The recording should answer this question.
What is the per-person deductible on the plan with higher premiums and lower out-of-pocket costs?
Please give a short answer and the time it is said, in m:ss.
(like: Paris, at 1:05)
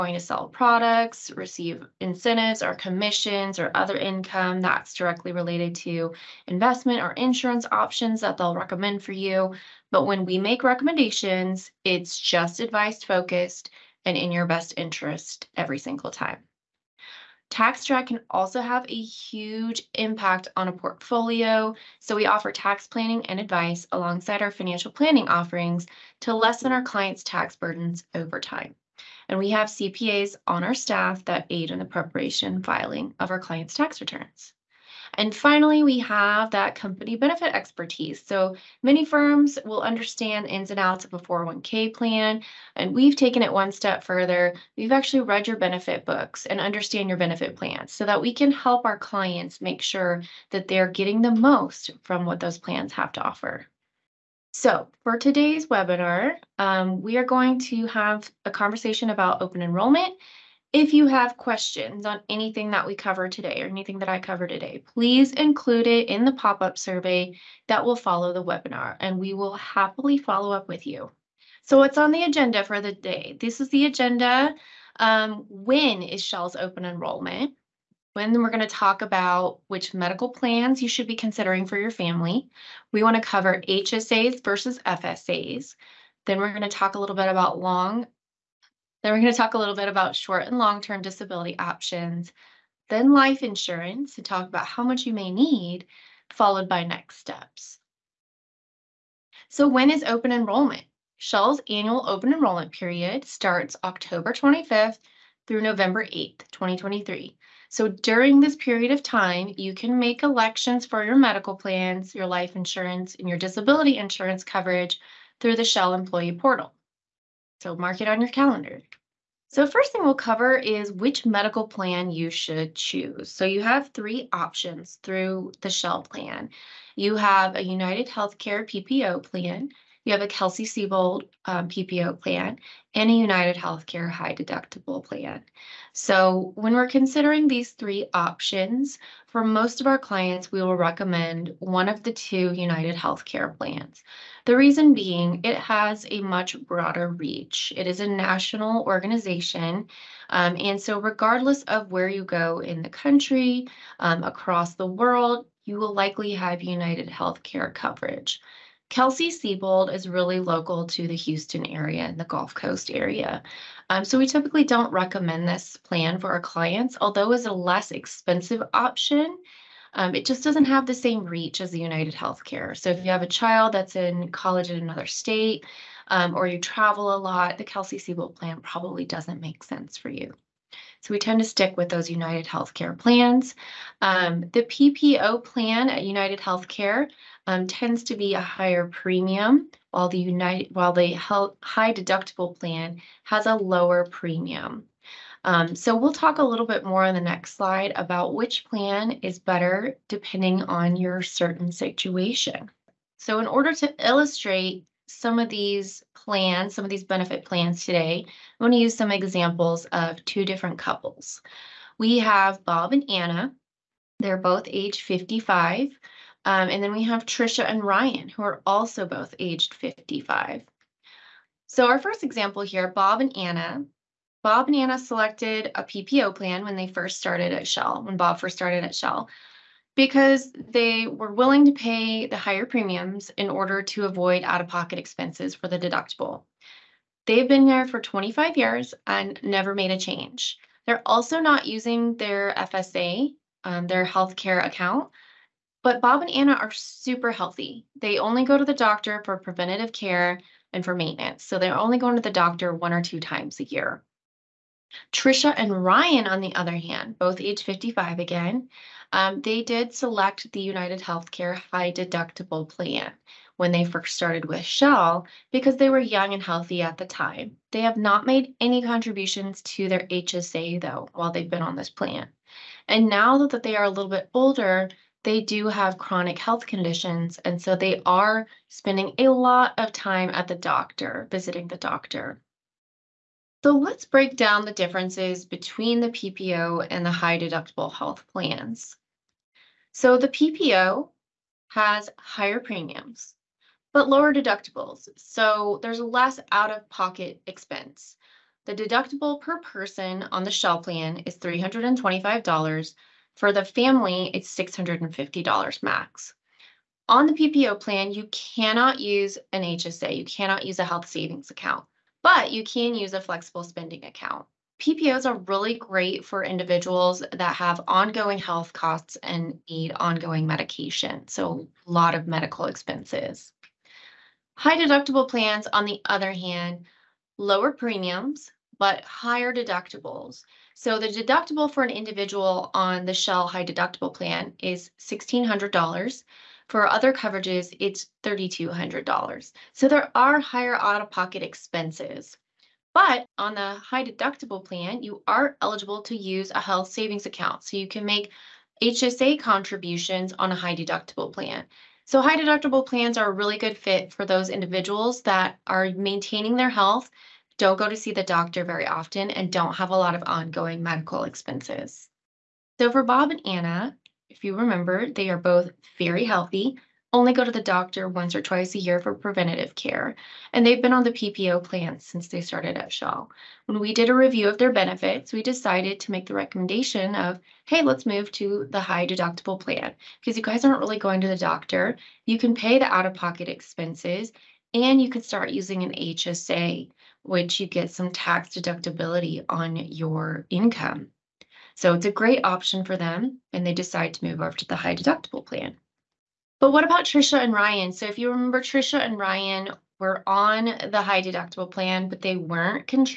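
$325, at 5:01.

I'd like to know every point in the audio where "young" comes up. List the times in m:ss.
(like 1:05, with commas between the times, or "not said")
4:25.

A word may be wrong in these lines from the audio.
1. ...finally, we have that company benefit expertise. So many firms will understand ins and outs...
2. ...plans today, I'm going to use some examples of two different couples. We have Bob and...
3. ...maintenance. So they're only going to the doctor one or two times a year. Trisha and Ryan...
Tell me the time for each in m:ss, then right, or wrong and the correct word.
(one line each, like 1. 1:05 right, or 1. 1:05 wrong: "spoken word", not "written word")
1. 0:35 right
2. 3:27 right
3. 4:10 right.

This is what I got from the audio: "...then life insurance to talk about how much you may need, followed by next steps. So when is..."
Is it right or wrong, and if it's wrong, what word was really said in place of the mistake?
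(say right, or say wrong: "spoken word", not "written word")
right.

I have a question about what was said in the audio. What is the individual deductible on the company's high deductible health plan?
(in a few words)
$1,600.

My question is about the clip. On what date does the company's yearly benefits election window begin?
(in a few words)
October 25th.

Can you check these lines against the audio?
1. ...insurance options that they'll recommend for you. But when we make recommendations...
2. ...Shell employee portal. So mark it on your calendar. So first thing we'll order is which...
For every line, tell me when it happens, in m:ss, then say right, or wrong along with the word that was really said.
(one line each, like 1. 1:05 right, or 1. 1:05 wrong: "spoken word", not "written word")
1. 0:07 right
2. 1:55 wrong: "cover", not "order".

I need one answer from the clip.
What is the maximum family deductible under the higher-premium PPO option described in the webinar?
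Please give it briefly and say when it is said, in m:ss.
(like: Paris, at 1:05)
$650, at 5:04.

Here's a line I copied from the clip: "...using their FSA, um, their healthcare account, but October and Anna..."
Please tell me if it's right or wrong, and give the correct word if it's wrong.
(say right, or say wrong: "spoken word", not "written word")
wrong: "Bob", not "October".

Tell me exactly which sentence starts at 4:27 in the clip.
They have not made any contributions to their HSA though while they've been on this plan.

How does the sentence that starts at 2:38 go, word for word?
Kelsey Seybold is really local to the Houston area and the Gulf Coast area.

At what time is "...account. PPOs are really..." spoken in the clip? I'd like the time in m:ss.
5:14.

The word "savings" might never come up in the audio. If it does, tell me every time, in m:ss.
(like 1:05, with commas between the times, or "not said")
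5:11, 5:46.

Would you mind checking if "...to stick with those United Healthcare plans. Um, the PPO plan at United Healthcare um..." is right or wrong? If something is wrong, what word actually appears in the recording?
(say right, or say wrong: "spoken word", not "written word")
right.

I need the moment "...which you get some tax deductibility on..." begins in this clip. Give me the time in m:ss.
6:27.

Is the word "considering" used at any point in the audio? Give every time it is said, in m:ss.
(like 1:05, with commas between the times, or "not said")
1:21, 2:16.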